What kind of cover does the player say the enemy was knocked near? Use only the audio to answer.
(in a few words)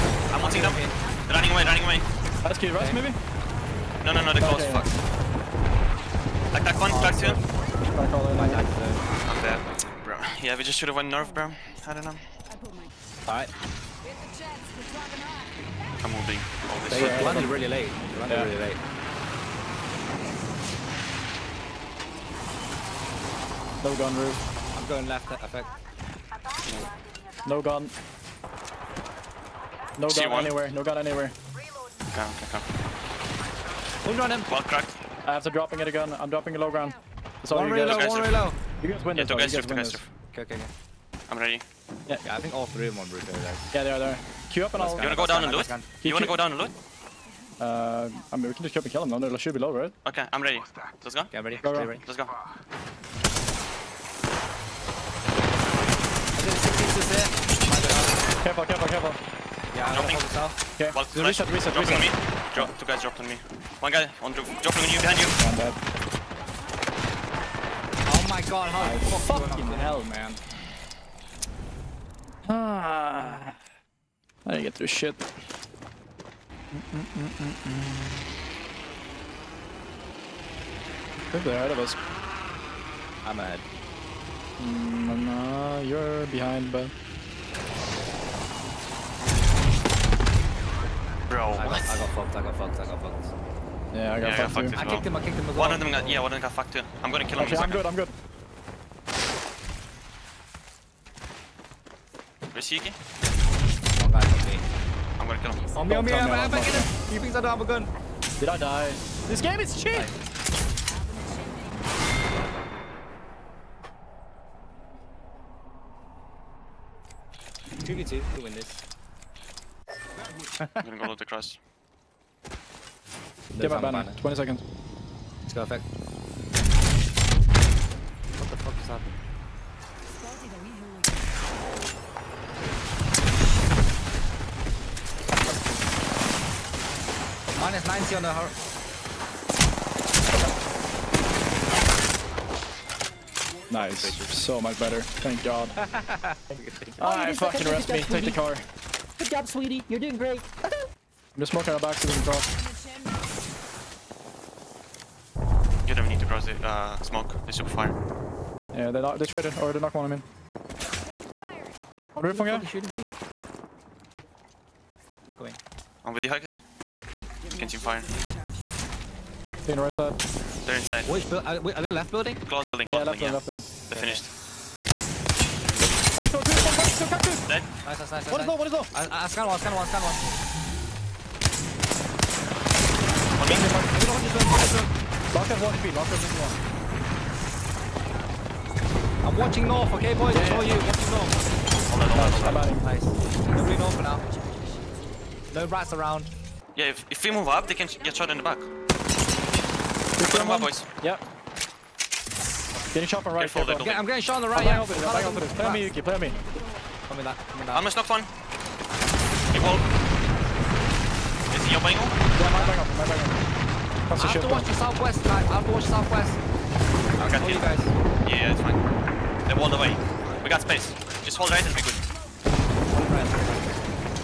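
Big wall.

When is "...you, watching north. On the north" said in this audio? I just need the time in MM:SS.
03:10.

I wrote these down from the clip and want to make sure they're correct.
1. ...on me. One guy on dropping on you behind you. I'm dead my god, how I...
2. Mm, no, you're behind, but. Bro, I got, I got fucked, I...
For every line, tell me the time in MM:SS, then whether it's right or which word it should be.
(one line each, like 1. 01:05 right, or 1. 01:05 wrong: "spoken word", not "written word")
1. 01:03 right
2. 01:24 right.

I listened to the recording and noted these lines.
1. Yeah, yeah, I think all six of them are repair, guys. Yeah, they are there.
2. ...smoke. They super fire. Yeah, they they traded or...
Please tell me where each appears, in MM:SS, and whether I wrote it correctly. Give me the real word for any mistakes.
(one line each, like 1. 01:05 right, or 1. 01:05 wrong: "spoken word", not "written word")
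1. 00:42 wrong: "three", not "six"
2. 02:37 right.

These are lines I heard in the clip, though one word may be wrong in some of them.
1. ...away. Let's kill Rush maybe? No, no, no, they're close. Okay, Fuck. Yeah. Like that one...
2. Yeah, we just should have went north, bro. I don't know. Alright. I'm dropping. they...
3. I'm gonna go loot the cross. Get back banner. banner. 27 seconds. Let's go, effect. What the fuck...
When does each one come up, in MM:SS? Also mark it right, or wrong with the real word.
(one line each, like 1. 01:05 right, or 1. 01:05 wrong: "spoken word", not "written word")
1. 00:01 right
2. 00:10 wrong: "moving", not "dropping"
3. 02:00 wrong: "20", not "27".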